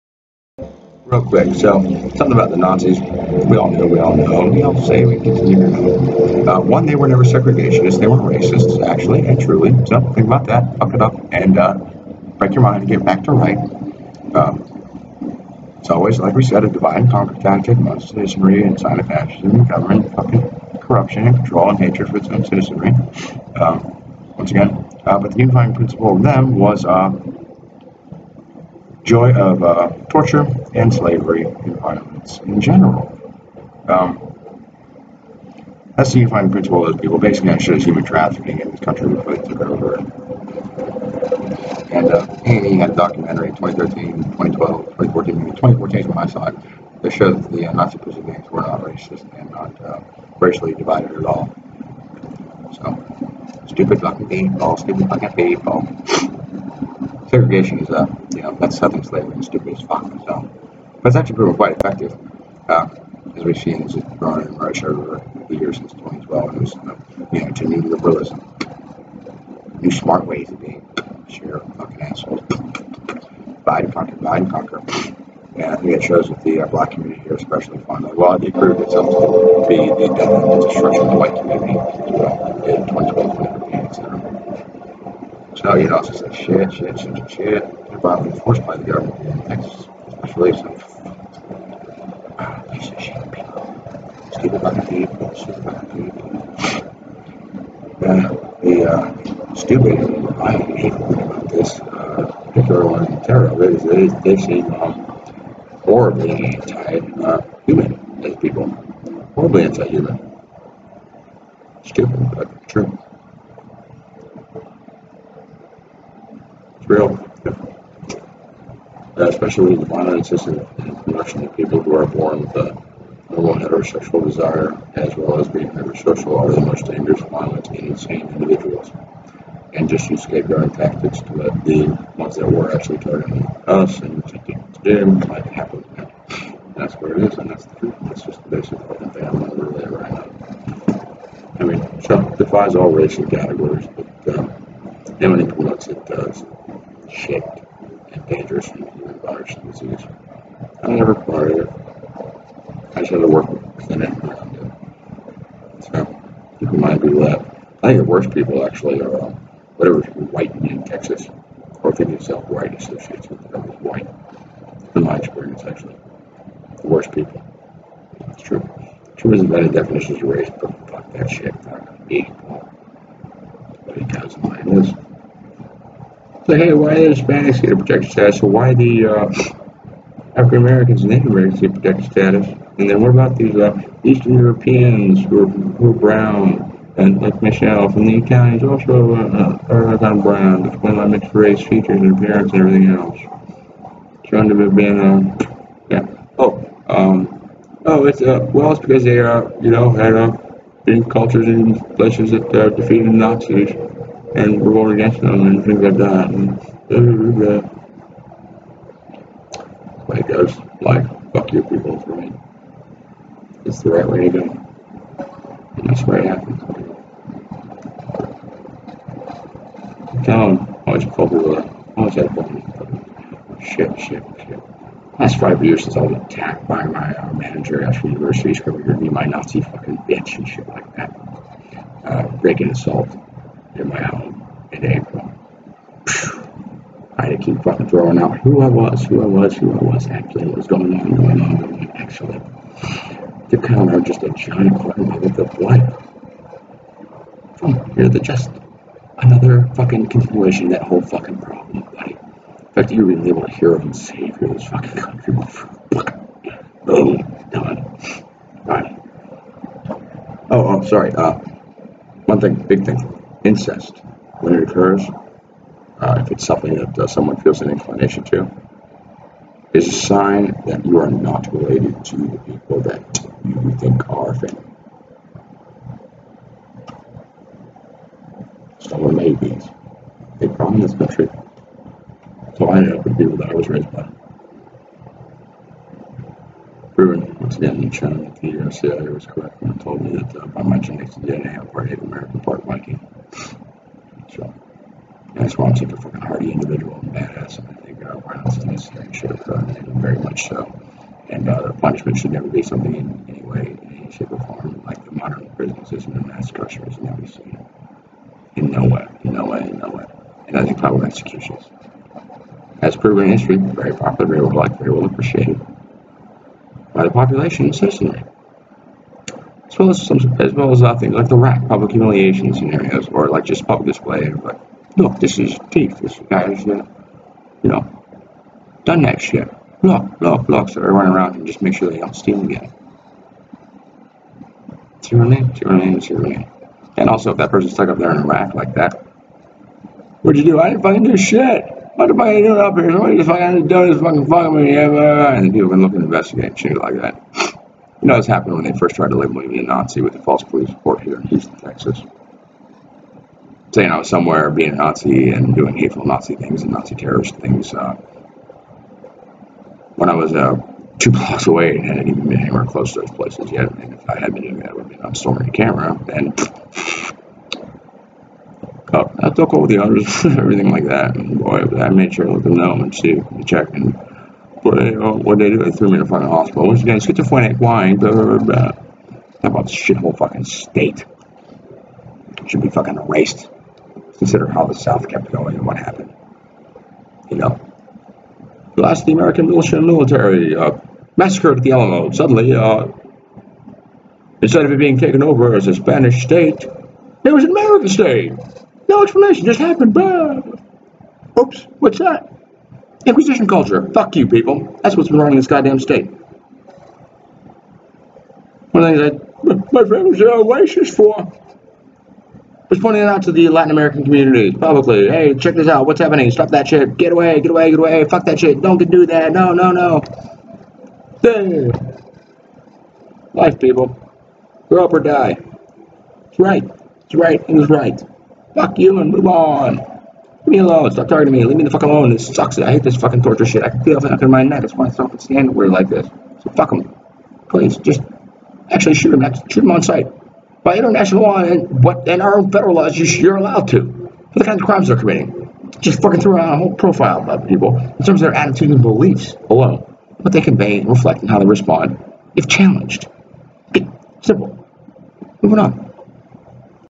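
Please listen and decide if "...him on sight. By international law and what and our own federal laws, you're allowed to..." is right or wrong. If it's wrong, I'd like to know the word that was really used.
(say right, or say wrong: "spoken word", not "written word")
right.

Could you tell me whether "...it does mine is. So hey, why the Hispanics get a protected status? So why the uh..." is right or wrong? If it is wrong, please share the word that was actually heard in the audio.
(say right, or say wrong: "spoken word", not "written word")
right.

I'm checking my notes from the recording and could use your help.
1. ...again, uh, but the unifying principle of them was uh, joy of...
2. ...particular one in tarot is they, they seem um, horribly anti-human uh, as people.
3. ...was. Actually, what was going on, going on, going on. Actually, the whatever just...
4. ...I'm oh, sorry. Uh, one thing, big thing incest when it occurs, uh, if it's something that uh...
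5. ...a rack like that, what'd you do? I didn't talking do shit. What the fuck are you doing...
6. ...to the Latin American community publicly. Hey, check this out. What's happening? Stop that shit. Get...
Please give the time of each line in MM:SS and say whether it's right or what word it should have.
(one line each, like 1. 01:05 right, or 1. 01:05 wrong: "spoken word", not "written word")
1. 00:24 right
2. 01:42 right
3. 03:59 wrong: "counter", not "whatever"
4. 04:20 right
5. 05:38 wrong: "fucking", not "talking"
6. 06:53 right.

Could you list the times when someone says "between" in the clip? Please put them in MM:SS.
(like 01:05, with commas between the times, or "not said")
not said.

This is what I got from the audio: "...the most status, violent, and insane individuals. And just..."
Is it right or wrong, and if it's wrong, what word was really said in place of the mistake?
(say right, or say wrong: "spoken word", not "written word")
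wrong: "dangerous", not "status".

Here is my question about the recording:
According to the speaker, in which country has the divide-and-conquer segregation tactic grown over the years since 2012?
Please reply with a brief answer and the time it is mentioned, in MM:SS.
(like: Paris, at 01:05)
Russia, at 01:04.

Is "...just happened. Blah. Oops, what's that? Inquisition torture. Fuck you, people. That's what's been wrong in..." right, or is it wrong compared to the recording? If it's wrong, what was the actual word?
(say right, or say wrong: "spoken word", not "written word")
wrong: "culture", not "torture".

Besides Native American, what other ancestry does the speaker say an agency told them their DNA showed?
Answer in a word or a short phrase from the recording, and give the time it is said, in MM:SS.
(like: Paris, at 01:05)
Viking, at 04:52.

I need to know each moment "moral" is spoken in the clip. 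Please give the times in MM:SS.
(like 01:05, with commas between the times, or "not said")
not said.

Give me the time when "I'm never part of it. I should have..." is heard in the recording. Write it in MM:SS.
02:30.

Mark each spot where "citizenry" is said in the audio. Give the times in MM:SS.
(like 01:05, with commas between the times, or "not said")
00:18, 00:22, 05:17.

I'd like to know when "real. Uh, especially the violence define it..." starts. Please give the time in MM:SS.
01:56.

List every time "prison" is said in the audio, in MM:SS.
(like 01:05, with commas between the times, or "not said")
00:47, 05:05.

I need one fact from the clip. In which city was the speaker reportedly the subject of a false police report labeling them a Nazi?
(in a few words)
Houston.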